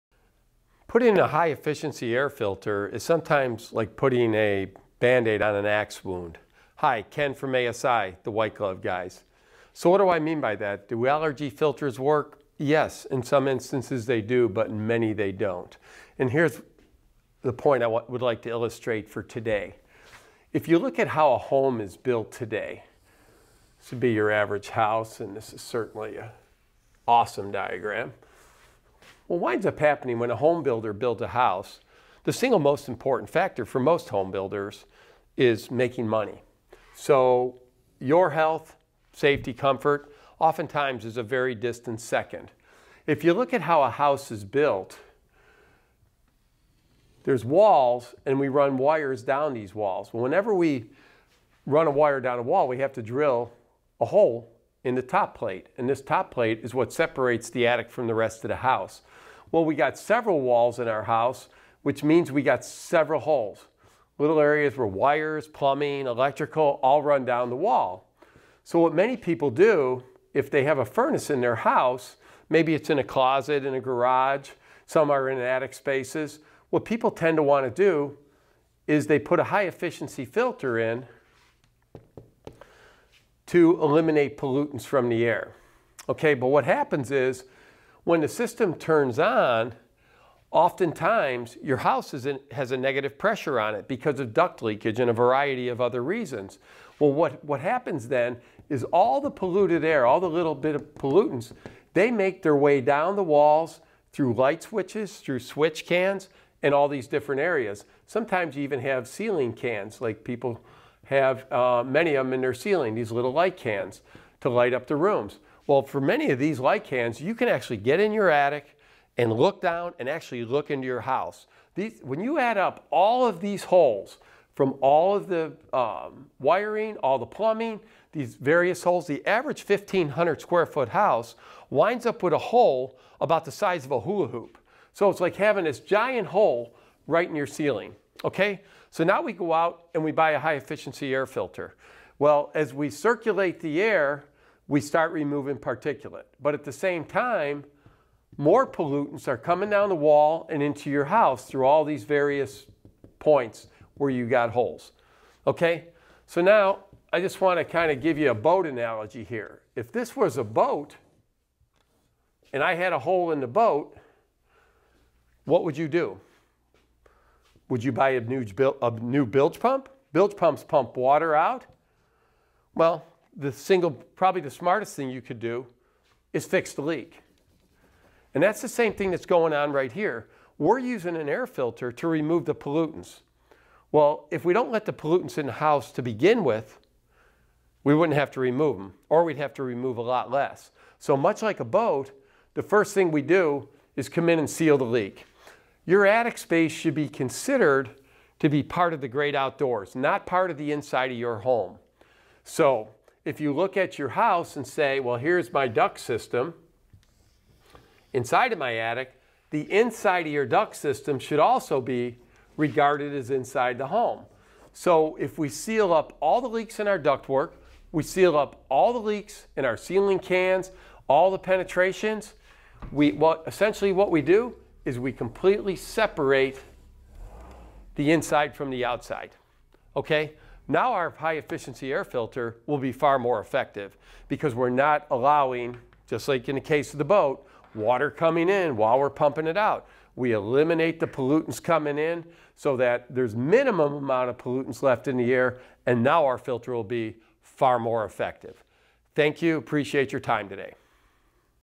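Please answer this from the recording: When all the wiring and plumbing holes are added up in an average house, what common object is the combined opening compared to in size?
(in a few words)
a hula hoop.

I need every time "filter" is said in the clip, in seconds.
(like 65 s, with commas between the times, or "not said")
2 s, 11 s, 80 s, 141 s, 181 s, 232 s, 246 s.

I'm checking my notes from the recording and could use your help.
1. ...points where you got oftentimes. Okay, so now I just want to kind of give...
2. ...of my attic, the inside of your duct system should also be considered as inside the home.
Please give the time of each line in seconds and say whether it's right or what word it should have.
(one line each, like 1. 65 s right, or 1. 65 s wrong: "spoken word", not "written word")
1. 153 s wrong: "holes", not "oftentimes"
2. 208 s wrong: "regarded", not "considered".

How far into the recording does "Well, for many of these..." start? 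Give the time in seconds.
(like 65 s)
115 s.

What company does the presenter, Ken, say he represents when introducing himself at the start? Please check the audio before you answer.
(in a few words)
ASI.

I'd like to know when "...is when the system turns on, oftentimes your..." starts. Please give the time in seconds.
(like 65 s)
87 s.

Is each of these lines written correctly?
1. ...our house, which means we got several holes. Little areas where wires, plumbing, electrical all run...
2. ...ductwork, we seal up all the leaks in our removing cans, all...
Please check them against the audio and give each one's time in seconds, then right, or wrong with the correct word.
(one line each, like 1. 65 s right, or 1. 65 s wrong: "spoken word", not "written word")
1. 60 s right
2. 216 s wrong: "ceiling", not "removing".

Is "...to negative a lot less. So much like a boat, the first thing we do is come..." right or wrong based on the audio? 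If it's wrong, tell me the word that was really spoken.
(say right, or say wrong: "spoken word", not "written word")
wrong: "remove", not "negative".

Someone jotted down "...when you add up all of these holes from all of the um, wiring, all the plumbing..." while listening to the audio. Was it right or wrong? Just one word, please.
right.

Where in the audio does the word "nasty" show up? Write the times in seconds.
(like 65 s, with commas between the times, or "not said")
not said.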